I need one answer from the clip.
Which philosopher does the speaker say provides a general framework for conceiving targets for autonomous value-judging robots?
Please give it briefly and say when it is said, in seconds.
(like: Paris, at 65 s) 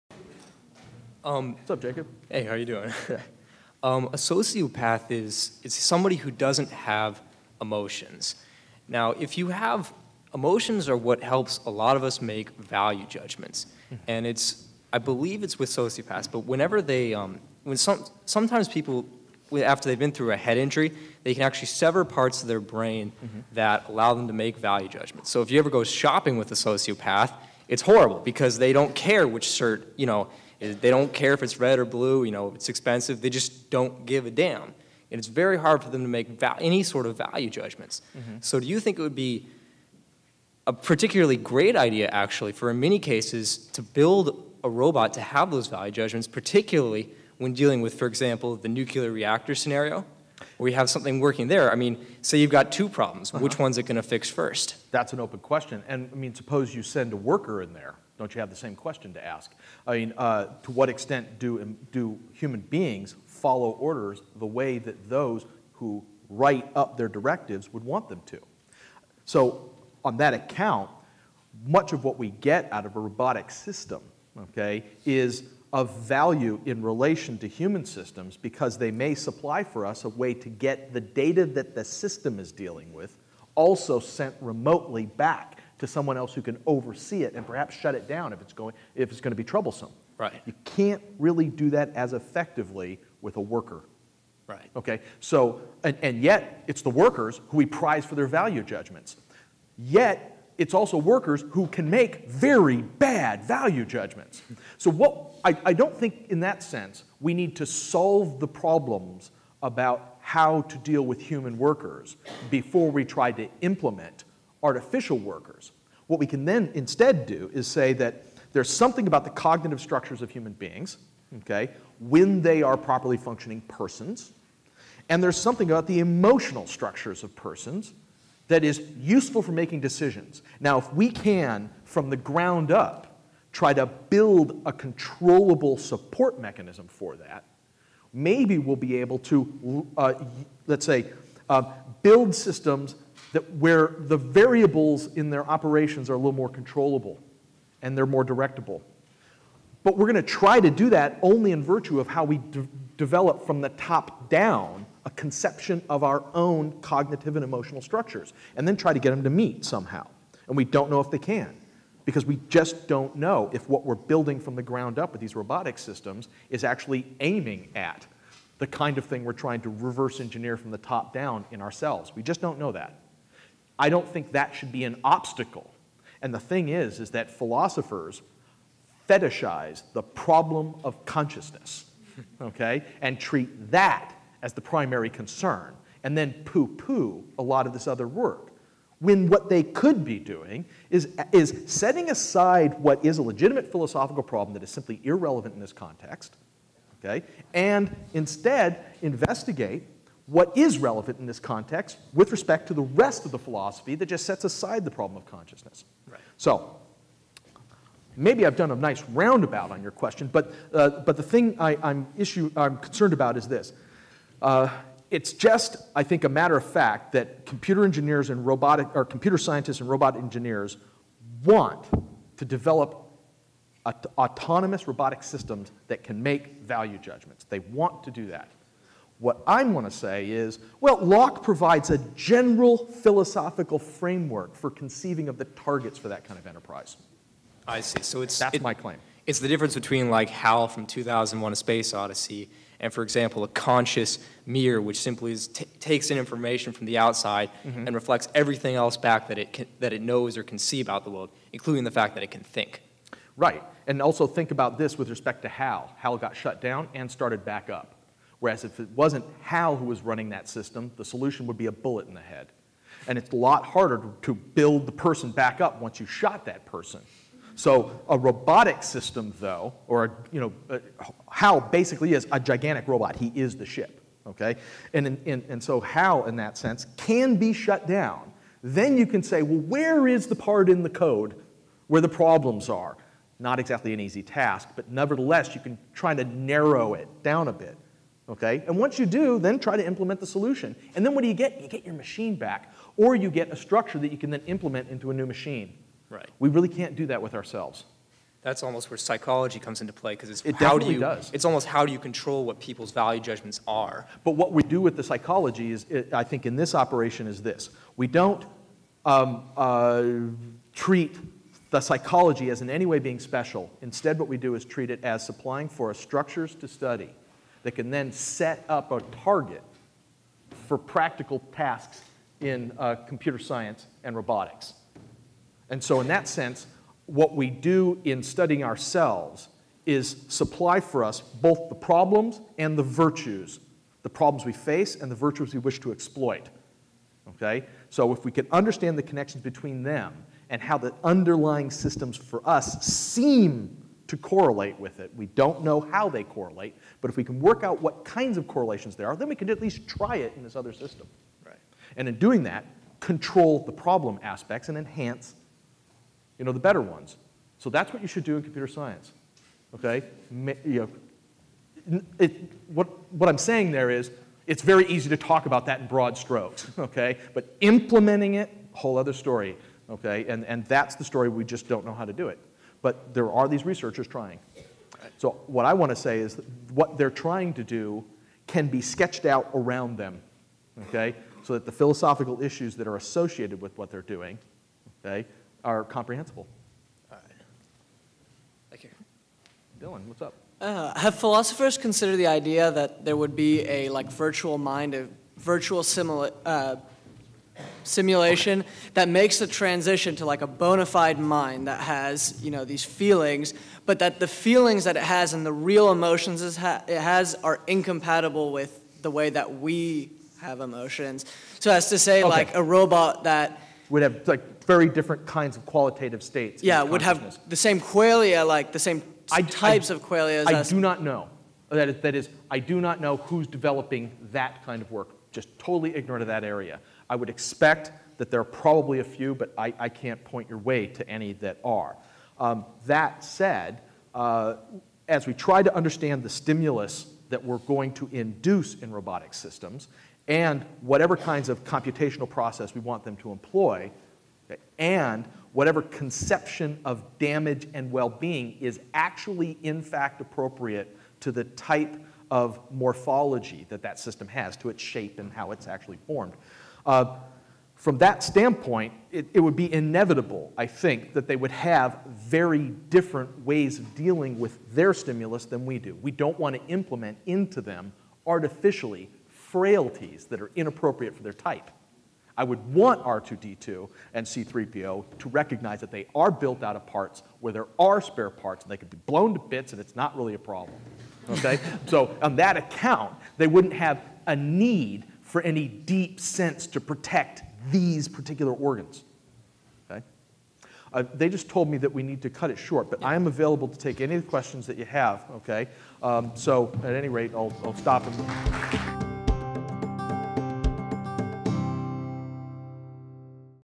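Locke, at 230 s.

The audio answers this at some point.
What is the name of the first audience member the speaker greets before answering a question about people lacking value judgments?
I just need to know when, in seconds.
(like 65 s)
1 s.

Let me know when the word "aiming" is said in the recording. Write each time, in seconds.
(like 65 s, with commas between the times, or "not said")
167 s.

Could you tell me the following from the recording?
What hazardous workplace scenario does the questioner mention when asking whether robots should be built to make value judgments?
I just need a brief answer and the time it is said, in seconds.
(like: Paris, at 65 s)
Nuclear reactor, at 48 s.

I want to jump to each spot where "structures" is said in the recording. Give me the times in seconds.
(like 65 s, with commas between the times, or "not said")
119 s, 126 s, 157 s, 293 s, 315 s.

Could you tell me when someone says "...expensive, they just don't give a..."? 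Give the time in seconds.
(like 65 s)
32 s.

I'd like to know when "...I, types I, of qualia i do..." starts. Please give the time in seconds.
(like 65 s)
419 s.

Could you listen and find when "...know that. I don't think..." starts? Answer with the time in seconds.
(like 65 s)
172 s.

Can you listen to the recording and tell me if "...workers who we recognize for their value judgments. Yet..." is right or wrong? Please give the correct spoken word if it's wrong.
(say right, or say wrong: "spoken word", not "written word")
wrong: "prize", not "recognize".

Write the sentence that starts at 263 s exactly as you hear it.
And it's a lot harder to build the person back up once you shot that person.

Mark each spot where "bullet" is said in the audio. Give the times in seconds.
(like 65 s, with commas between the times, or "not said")
261 s.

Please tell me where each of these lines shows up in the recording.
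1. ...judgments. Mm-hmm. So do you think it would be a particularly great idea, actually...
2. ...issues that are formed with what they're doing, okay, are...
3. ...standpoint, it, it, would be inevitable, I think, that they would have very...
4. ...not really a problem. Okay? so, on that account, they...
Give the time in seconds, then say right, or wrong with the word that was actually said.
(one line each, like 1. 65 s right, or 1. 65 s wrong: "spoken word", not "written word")
1. 37 s right
2. 382 s wrong: "associated", not "formed"
3. 458 s right
4. 479 s right.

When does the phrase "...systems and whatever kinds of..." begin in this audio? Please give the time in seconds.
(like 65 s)
439 s.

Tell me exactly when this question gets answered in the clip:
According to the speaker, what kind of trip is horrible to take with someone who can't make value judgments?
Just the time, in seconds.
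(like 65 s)
25 s.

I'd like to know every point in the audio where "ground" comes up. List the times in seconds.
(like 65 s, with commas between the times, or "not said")
132 s, 164 s.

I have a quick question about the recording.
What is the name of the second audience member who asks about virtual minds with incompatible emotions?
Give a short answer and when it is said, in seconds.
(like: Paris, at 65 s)
Dylan, at 389 s.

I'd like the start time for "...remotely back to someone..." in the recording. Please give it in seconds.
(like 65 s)
84 s.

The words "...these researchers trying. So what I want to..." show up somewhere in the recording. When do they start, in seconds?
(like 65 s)
373 s.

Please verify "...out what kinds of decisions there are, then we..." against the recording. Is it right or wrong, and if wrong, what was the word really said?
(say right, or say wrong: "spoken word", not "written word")
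wrong: "correlations", not "decisions".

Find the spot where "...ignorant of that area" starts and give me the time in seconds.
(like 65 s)
425 s.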